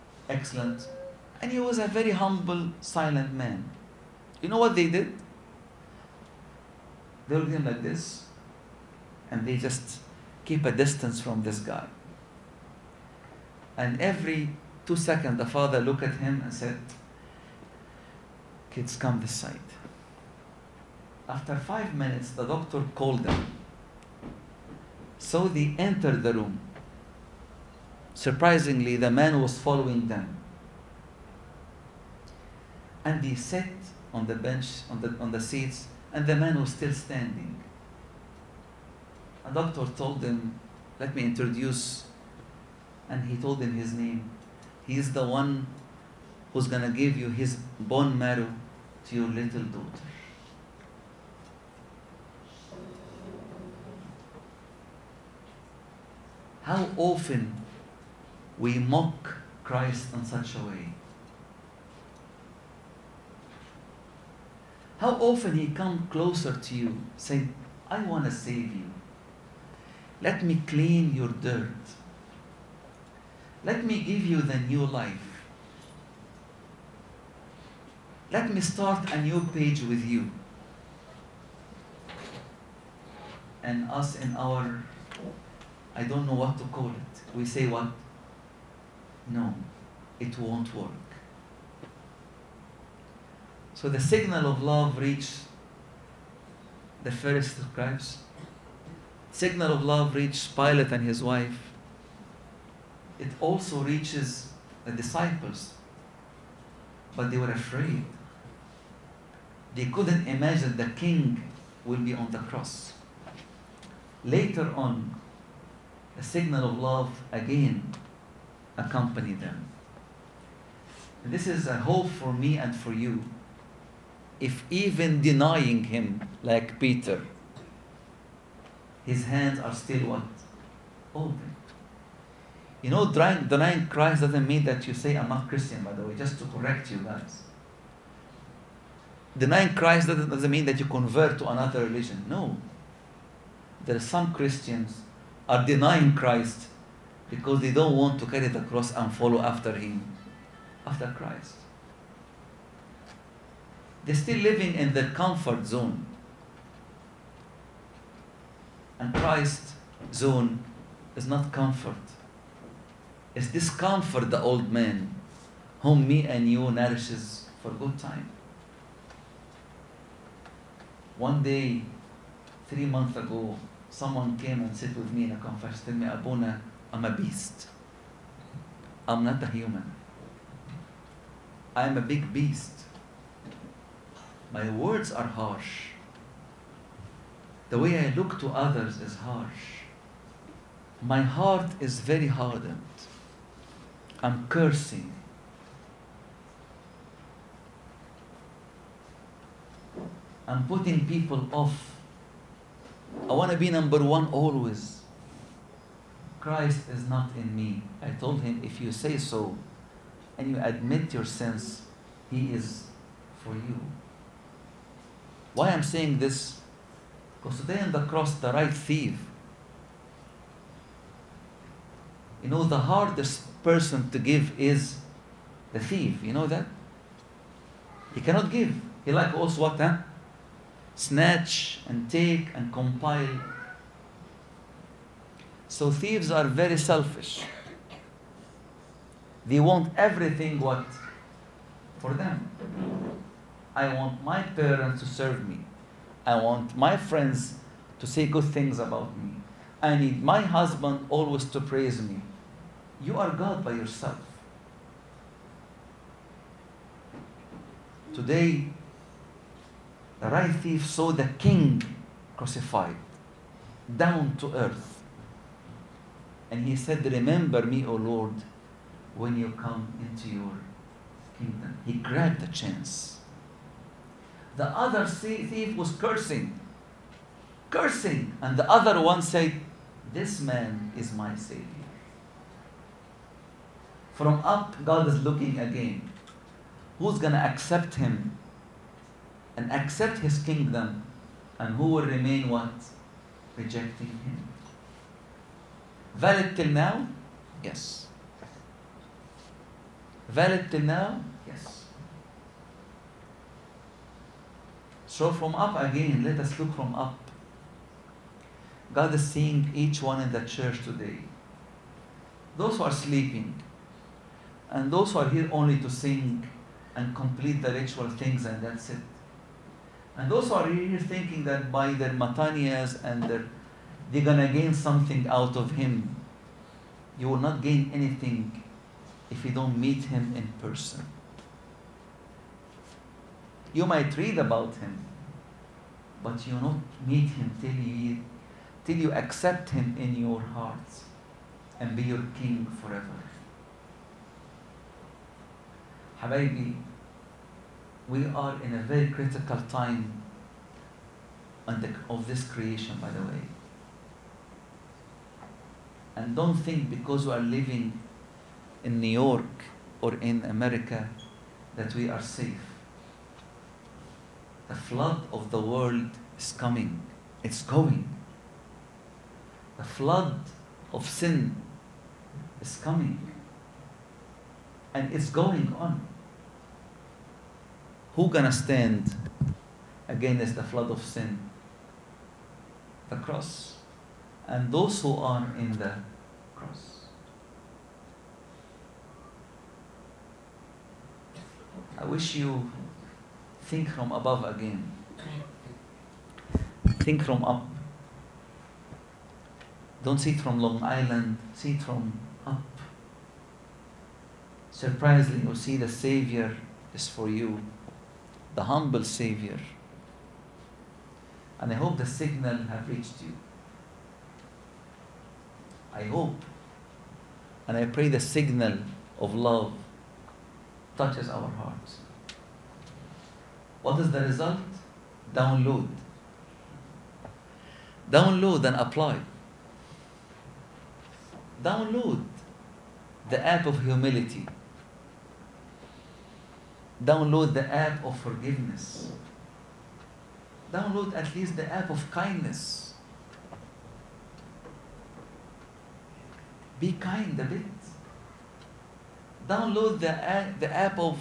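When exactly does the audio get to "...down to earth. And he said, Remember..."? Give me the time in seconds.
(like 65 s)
263 s.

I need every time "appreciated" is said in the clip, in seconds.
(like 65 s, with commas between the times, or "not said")
not said.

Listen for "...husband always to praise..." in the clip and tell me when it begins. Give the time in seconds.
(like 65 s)
250 s.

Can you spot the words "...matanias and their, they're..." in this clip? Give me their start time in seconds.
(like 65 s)
322 s.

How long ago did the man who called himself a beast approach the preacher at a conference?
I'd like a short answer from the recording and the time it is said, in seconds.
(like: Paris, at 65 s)
3 months, at 172 s.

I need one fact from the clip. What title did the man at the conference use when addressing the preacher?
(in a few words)
Abuna.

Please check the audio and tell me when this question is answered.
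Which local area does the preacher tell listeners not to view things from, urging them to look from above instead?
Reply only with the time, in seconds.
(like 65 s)
400 s.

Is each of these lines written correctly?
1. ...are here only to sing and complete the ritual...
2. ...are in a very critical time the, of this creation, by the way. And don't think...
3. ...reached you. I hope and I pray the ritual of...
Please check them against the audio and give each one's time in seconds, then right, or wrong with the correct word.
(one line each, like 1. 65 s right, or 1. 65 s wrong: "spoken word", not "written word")
1. 315 s right
2. 348 s right
3. 412 s wrong: "signal", not "ritual".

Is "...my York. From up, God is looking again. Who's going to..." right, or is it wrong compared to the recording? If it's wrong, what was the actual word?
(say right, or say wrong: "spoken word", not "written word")
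wrong: "Savior", not "York".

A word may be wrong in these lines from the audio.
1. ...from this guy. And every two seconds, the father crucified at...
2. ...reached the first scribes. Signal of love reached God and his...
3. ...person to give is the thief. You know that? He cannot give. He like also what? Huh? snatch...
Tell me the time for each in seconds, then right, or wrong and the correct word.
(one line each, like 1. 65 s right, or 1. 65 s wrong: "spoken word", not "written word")
1. 11 s wrong: "looked", not "crucified"
2. 94 s wrong: "Pilate", not "God"
3. 223 s right.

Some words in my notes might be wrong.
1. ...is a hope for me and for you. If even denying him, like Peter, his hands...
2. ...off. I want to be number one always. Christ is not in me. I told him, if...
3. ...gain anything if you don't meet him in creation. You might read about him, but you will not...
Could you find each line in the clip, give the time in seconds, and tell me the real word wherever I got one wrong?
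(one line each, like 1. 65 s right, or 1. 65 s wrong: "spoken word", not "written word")
1. 121 s right
2. 201 s right
3. 327 s wrong: "person", not "creation".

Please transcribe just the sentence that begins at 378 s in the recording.
Who gonna stand against the flood of sin?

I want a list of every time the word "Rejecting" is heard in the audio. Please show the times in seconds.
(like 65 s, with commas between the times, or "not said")
293 s.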